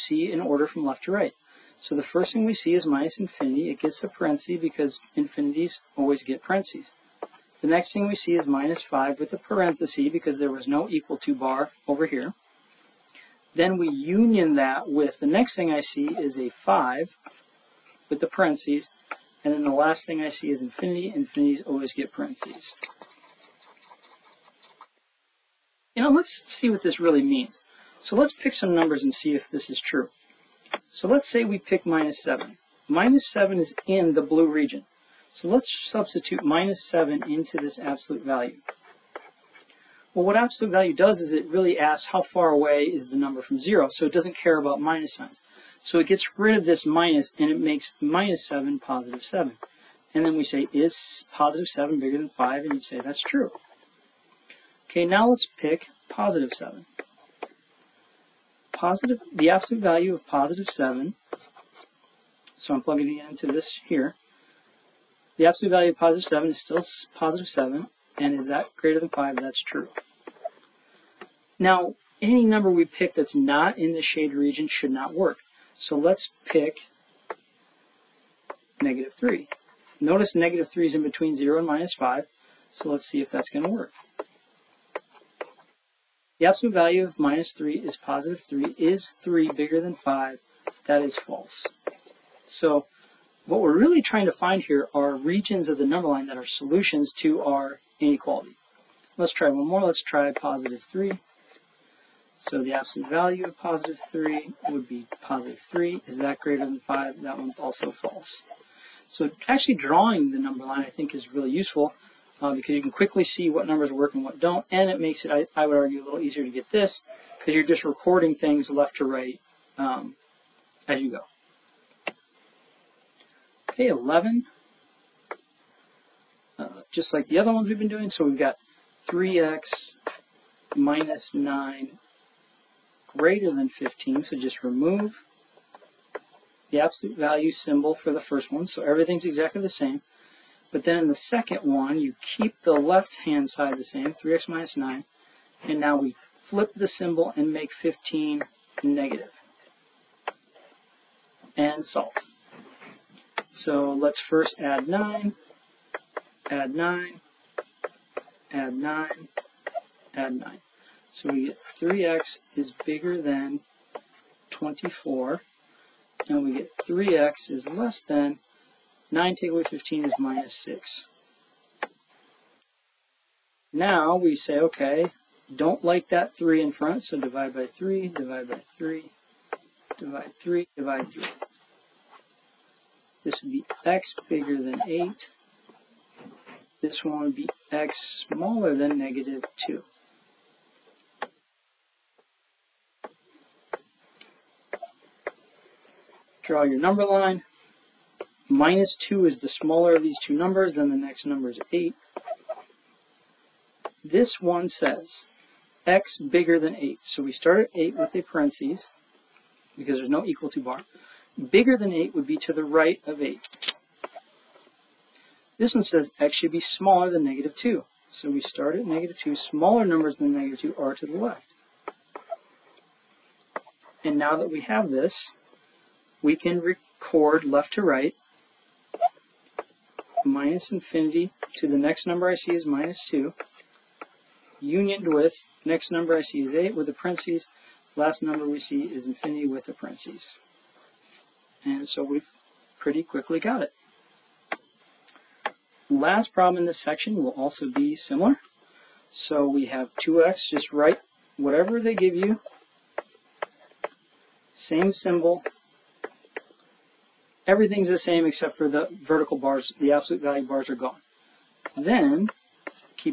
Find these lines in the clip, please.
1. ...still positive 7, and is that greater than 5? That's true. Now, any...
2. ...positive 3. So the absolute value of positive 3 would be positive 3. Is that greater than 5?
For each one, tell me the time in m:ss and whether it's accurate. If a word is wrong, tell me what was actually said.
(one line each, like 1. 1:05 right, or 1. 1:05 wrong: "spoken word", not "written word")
1. 1:06 right
2. 1:40 right.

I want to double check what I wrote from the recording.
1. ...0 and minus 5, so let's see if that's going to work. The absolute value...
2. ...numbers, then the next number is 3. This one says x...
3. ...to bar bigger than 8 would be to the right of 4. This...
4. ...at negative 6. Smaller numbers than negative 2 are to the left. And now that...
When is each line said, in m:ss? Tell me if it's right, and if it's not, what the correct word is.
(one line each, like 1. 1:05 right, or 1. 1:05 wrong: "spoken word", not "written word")
1. 1:21 right
2. 3:20 wrong: "8", not "3"
3. 3:30 wrong: "8", not "4"
4. 3:38 wrong: "2", not "6".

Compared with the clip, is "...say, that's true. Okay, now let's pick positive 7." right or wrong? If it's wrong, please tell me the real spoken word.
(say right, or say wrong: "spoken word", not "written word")
right.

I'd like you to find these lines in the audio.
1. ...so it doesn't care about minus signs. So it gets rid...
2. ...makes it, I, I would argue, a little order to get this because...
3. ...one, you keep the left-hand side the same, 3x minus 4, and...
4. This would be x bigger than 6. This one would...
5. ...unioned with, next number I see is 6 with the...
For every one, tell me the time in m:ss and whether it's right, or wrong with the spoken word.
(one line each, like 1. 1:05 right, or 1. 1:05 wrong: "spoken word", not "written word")
1. 0:43 right
2. 1:54 wrong: "easier", not "order"
3. 2:21 wrong: "9", not "4"
4. 3:03 wrong: "8", not "6"
5. 3:54 wrong: "8", not "6".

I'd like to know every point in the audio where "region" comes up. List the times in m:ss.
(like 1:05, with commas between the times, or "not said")
0:34, 1:14, 1:35.